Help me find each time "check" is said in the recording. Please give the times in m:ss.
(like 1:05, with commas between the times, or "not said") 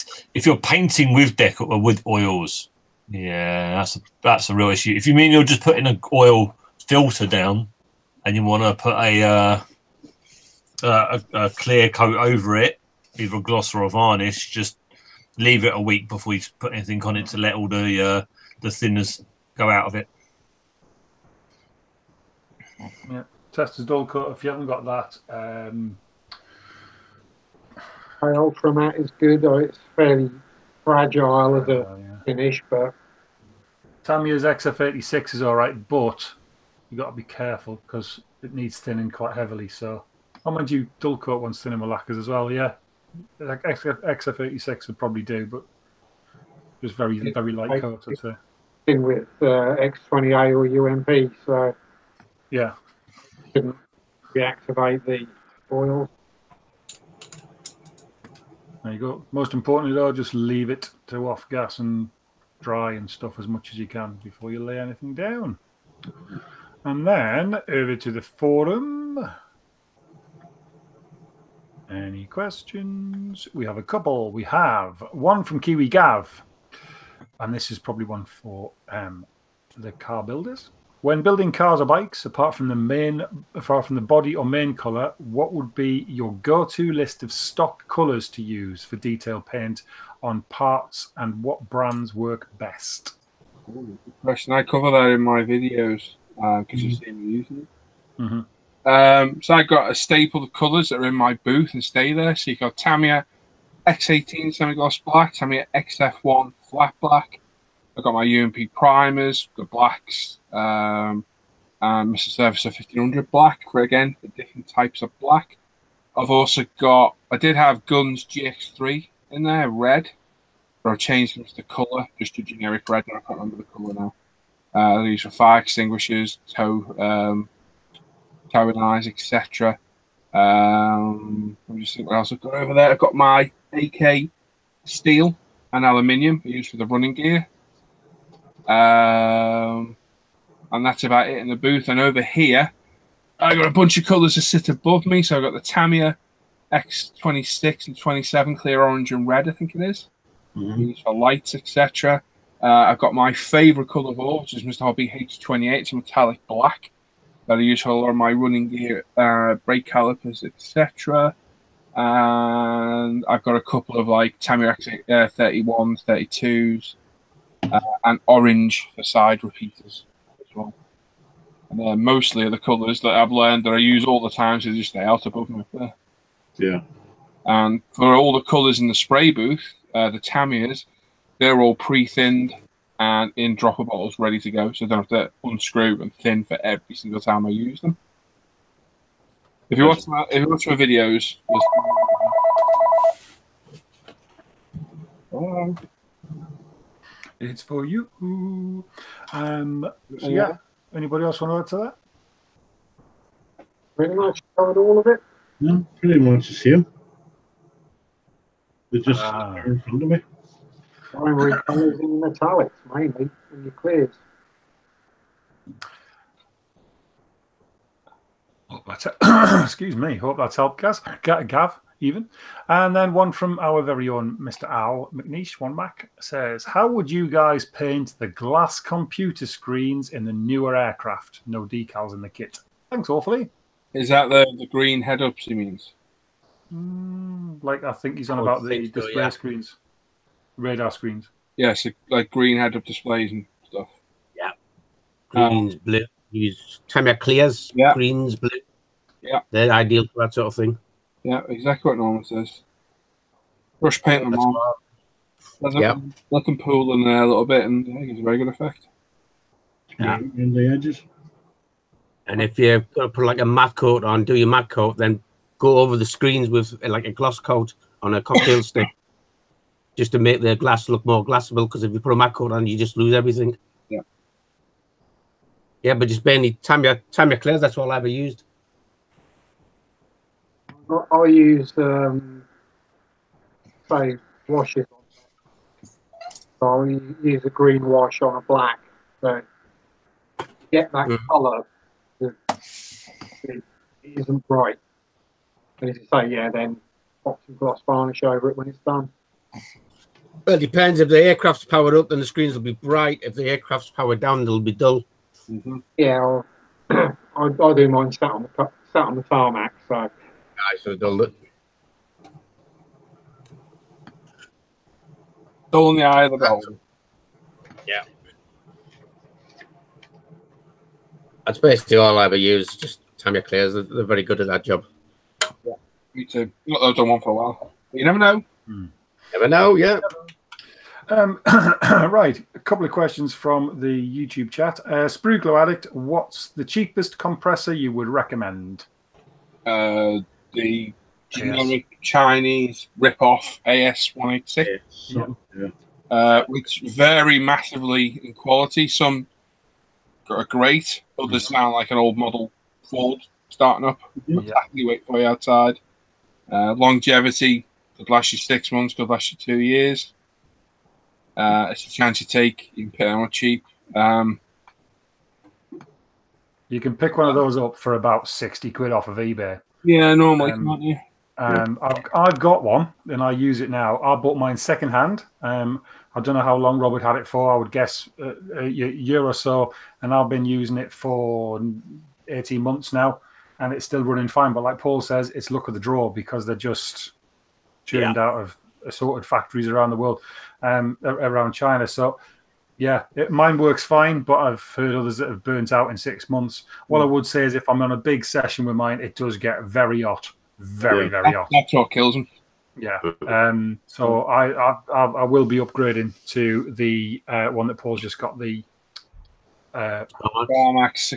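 not said.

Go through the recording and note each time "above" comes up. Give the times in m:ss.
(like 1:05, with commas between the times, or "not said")
2:24, 2:55.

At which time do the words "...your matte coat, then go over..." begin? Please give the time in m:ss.
4:24.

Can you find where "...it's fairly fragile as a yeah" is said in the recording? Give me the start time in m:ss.
0:29.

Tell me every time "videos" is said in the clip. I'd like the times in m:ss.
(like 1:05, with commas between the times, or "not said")
1:35, 3:10.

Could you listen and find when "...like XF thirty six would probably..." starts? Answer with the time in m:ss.
0:43.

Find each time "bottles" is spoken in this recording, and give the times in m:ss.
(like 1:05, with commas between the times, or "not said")
3:03.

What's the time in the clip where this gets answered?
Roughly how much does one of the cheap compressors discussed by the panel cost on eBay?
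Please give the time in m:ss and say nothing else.
6:08.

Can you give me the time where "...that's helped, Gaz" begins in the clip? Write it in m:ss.
3:40.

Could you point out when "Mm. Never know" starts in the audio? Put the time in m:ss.
5:28.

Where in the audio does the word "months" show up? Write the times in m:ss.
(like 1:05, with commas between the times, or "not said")
5:58, 6:22, 6:36.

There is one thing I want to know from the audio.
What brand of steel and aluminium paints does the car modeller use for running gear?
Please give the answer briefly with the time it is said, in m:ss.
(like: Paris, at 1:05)
AK, at 2:13.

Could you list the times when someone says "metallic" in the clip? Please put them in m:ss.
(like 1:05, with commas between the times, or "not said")
2:35, 3:32.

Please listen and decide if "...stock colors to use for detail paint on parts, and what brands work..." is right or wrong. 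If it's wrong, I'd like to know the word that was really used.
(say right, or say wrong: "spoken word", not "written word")
right.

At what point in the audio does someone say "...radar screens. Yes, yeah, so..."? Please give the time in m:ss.
4:00.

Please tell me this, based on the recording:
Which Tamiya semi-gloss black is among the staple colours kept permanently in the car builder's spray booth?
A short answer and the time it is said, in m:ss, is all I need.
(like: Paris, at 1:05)
X18, at 1:42.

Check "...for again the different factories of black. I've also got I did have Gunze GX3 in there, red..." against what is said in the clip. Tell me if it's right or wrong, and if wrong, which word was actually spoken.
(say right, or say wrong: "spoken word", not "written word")
wrong: "types", not "factories".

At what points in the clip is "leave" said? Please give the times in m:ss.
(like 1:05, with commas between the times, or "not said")
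0:15, 1:00.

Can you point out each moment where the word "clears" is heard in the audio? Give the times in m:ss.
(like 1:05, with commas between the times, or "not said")
0:11, 2:28, 3:33, 4:07, 4:37, 5:23.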